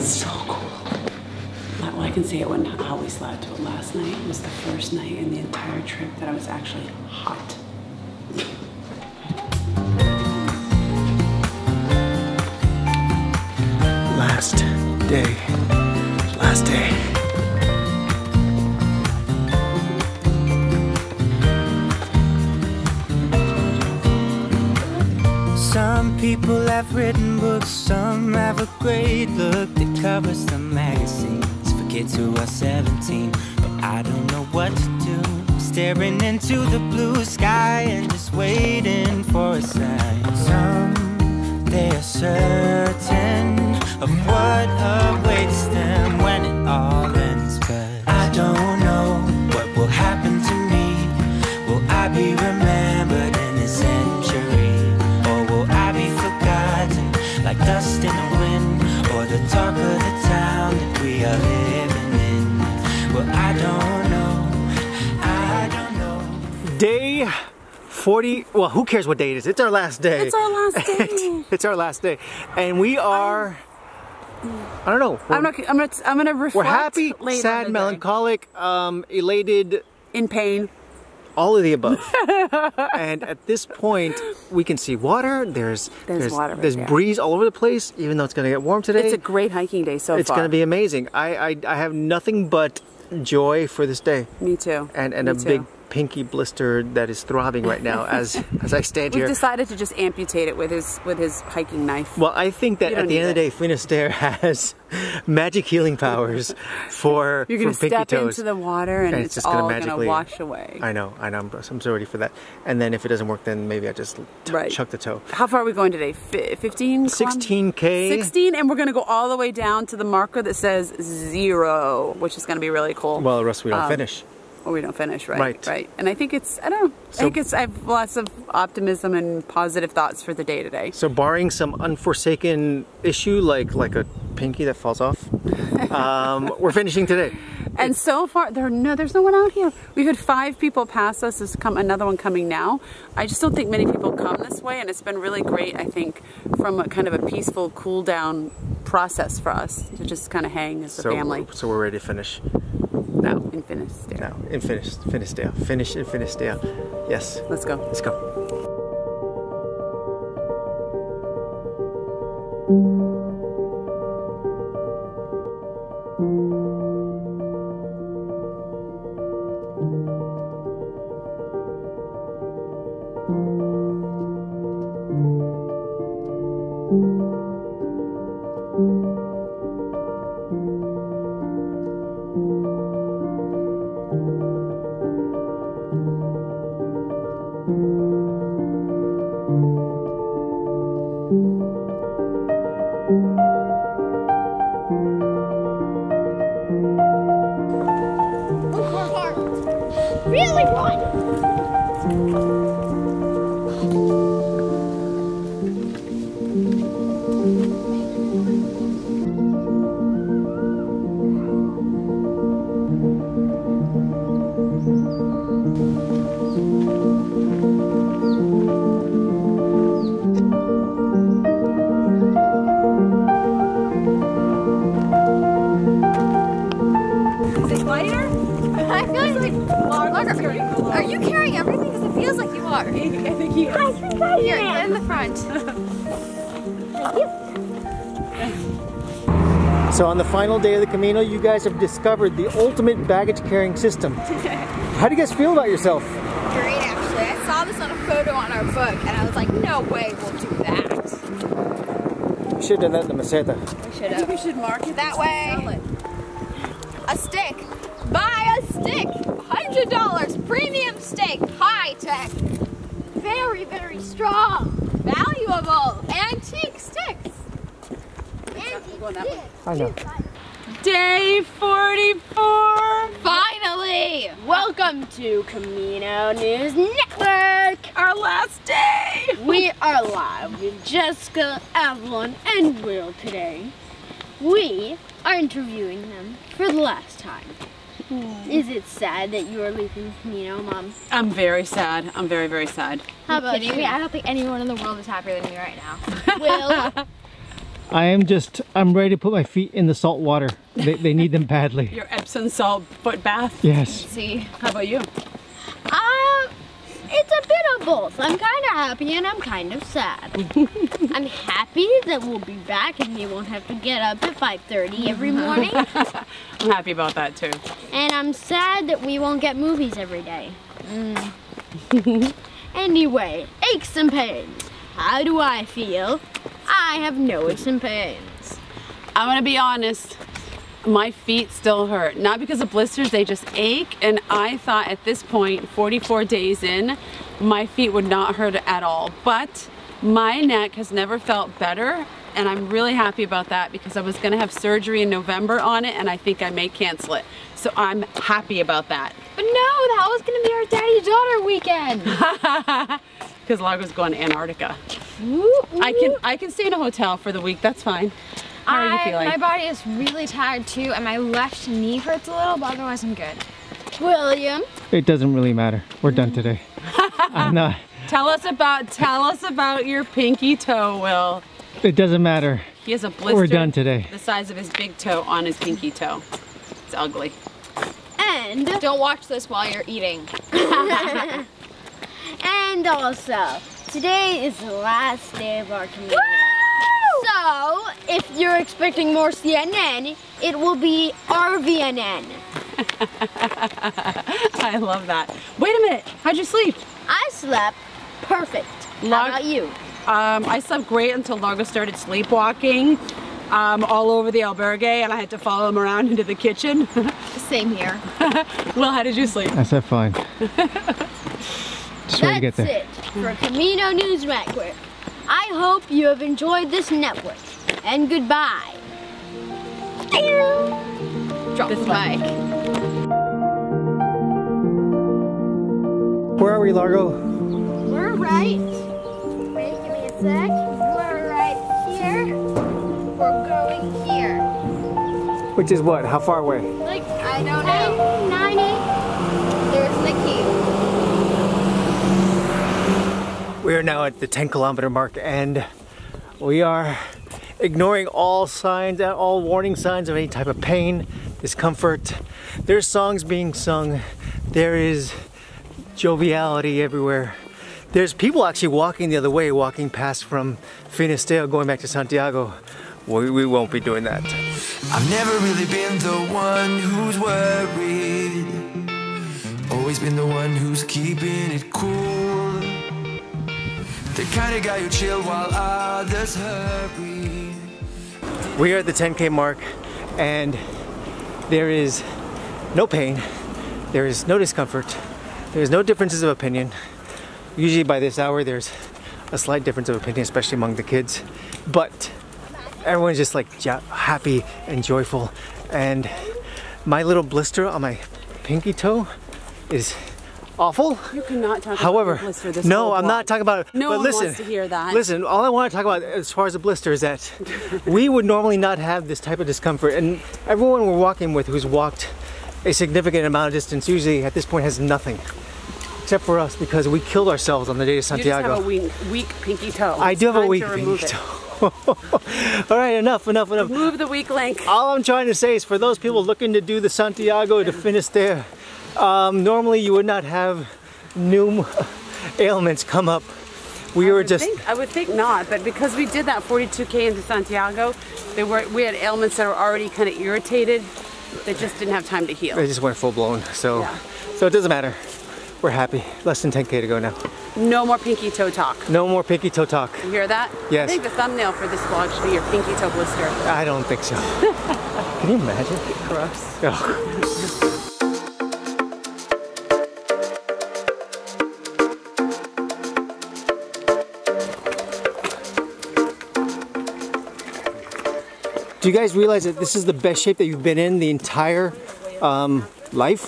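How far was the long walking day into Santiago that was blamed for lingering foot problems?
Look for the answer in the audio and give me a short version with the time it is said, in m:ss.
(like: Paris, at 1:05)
42 km, at 8:56.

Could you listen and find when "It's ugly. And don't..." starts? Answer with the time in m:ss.
6:16.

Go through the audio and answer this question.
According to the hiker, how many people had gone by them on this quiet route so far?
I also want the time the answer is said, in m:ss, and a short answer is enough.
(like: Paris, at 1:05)
5, at 2:20.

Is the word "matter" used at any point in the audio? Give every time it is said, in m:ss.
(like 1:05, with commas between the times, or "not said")
6:05, 6:12, 9:04.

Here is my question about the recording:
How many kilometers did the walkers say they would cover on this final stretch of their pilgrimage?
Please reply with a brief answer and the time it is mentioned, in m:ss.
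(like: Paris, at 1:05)
16, at 1:57.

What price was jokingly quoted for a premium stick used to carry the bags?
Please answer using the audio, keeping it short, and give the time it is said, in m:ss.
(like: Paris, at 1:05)
$100, at 4:19.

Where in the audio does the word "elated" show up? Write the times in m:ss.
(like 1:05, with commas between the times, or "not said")
1:19.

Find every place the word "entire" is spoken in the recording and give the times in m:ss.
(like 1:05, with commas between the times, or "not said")
0:05, 9:31.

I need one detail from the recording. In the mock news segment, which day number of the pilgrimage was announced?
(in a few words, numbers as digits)
Day 44.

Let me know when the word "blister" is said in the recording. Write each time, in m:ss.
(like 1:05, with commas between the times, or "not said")
1:36, 5:32, 6:13, 8:17, 8:26, 9:12.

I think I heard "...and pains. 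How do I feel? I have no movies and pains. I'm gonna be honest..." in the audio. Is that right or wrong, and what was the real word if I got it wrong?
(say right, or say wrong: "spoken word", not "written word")
wrong: "aches", not "movies".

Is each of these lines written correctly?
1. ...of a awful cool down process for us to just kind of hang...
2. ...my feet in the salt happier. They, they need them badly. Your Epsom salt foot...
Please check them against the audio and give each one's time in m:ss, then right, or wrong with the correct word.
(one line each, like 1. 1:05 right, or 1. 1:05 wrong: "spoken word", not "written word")
1. 2:27 wrong: "peaceful", not "awful"
2. 4:59 wrong: "water", not "happier".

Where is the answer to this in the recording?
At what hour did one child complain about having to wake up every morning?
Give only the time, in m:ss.
5:14.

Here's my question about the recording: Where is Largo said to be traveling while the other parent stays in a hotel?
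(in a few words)
Antarctica.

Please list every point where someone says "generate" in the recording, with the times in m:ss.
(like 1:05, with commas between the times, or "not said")
not said.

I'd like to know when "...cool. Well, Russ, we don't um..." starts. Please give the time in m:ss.
2:02.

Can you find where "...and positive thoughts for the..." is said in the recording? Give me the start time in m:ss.
2:09.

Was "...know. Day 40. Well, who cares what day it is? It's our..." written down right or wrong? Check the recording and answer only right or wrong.
right.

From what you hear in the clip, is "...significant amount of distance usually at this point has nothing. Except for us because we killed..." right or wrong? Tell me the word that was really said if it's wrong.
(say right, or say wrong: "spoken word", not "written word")
right.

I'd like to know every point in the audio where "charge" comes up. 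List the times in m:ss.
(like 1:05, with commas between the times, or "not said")
not said.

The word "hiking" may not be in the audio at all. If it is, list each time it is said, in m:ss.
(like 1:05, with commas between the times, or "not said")
1:29, 1:41.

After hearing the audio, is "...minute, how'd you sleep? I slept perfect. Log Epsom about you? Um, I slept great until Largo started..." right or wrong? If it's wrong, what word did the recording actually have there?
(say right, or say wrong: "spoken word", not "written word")
wrong: "How", not "Epsom".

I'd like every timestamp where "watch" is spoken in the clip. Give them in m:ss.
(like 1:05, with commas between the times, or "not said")
6:18.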